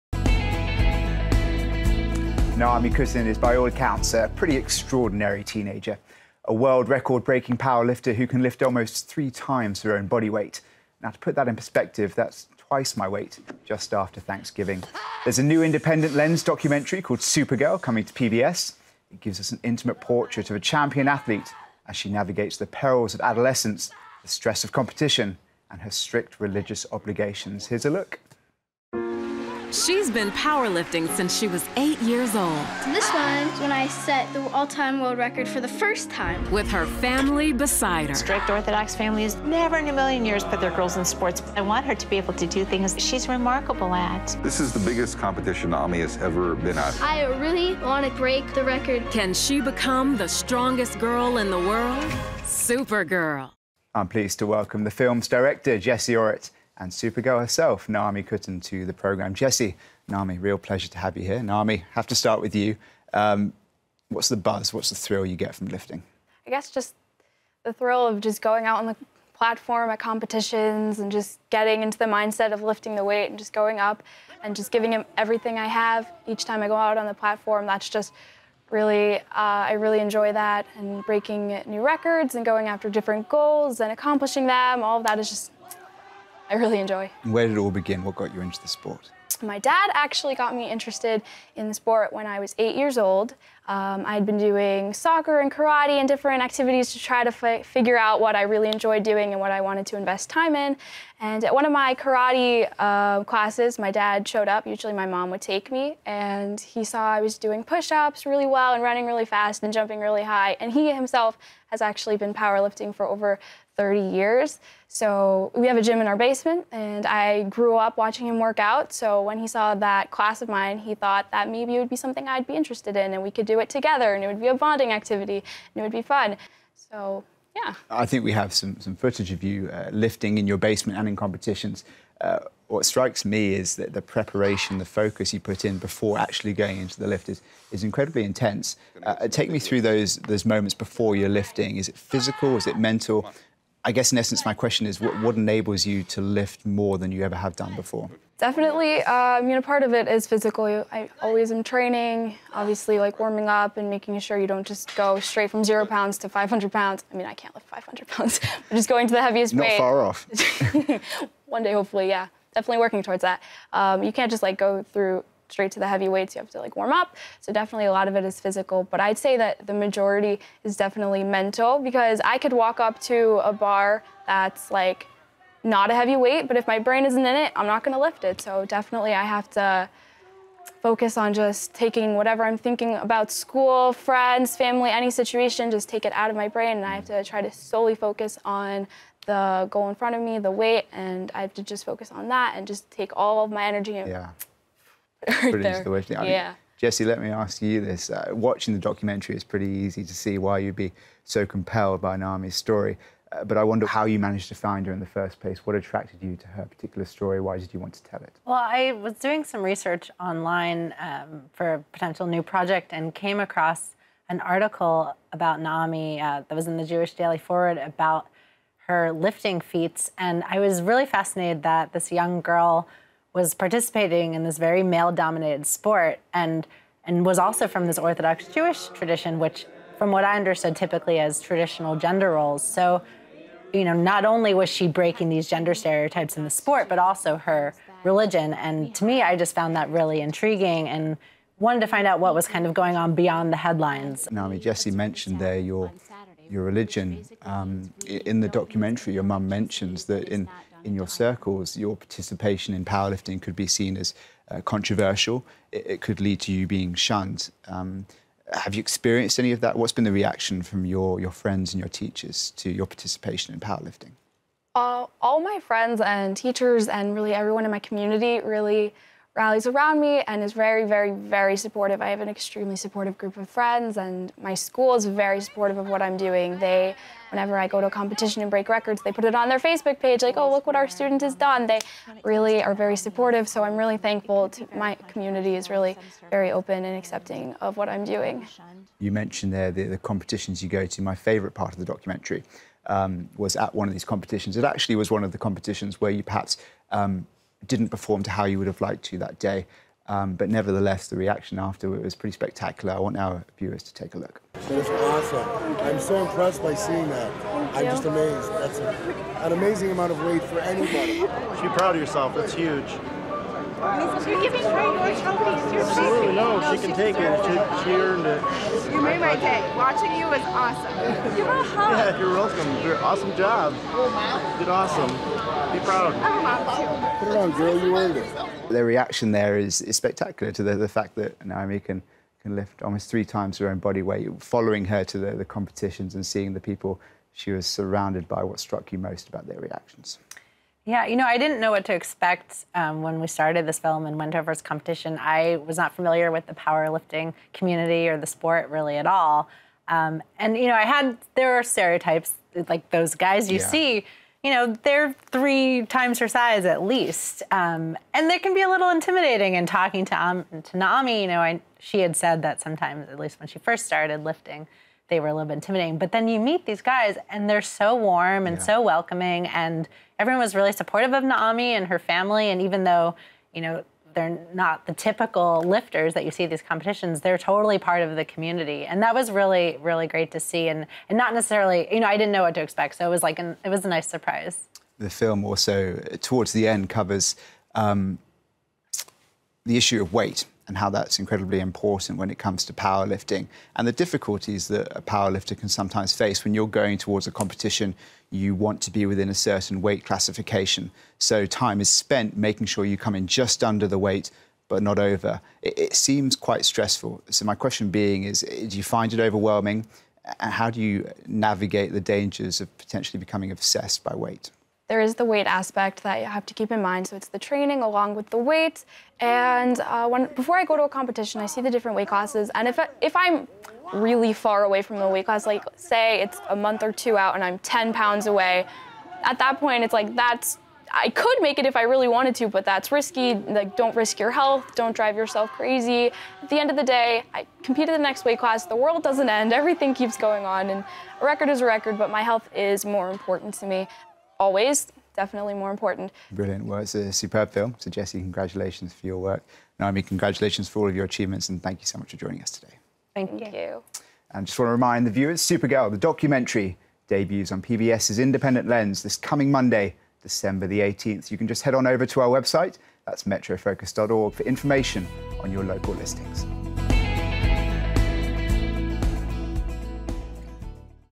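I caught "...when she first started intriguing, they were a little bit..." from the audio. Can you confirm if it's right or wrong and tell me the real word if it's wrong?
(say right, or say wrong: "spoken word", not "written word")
wrong: "lifting", not "intriguing".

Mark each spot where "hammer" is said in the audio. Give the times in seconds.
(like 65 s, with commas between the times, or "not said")
not said.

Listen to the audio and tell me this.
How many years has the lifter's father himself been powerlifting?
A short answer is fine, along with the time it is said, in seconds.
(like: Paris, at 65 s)
over 30 years, at 113 s.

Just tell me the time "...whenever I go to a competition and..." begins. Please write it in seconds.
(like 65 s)
277 s.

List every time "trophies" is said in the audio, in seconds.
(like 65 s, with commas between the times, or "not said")
315 s.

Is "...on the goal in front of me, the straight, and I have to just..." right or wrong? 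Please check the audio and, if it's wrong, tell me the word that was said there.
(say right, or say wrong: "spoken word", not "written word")
wrong: "weight", not "straight".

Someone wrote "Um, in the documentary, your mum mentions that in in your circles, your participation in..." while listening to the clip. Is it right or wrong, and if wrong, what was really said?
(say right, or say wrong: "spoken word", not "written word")
right.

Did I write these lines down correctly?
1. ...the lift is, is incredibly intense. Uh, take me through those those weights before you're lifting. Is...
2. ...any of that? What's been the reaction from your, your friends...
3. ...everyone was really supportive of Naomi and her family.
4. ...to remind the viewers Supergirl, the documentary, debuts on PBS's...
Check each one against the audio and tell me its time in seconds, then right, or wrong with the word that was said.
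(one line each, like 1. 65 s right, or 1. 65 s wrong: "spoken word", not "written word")
1. 136 s wrong: "moments", not "weights"
2. 259 s right
3. 370 s right
4. 454 s right.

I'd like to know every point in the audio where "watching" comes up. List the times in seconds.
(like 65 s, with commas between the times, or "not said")
117 s, 198 s, 319 s.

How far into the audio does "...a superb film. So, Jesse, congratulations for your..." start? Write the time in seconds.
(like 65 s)
446 s.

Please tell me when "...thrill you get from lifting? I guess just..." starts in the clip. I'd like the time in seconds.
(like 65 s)
64 s.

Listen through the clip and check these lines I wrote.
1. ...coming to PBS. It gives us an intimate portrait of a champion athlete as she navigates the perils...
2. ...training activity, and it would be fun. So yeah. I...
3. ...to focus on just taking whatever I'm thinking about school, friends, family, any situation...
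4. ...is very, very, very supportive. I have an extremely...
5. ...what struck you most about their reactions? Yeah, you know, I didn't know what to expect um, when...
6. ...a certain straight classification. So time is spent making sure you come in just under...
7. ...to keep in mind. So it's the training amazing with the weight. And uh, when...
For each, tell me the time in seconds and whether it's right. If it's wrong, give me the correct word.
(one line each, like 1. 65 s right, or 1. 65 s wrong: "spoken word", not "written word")
1. 17 s right
2. 124 s wrong: "bonding", not "training"
3. 179 s right
4. 270 s right
5. 338 s right
6. 399 s wrong: "weight", not "straight"
7. 416 s wrong: "along", not "amazing".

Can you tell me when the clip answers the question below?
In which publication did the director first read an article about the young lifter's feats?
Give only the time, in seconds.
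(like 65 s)
216 s.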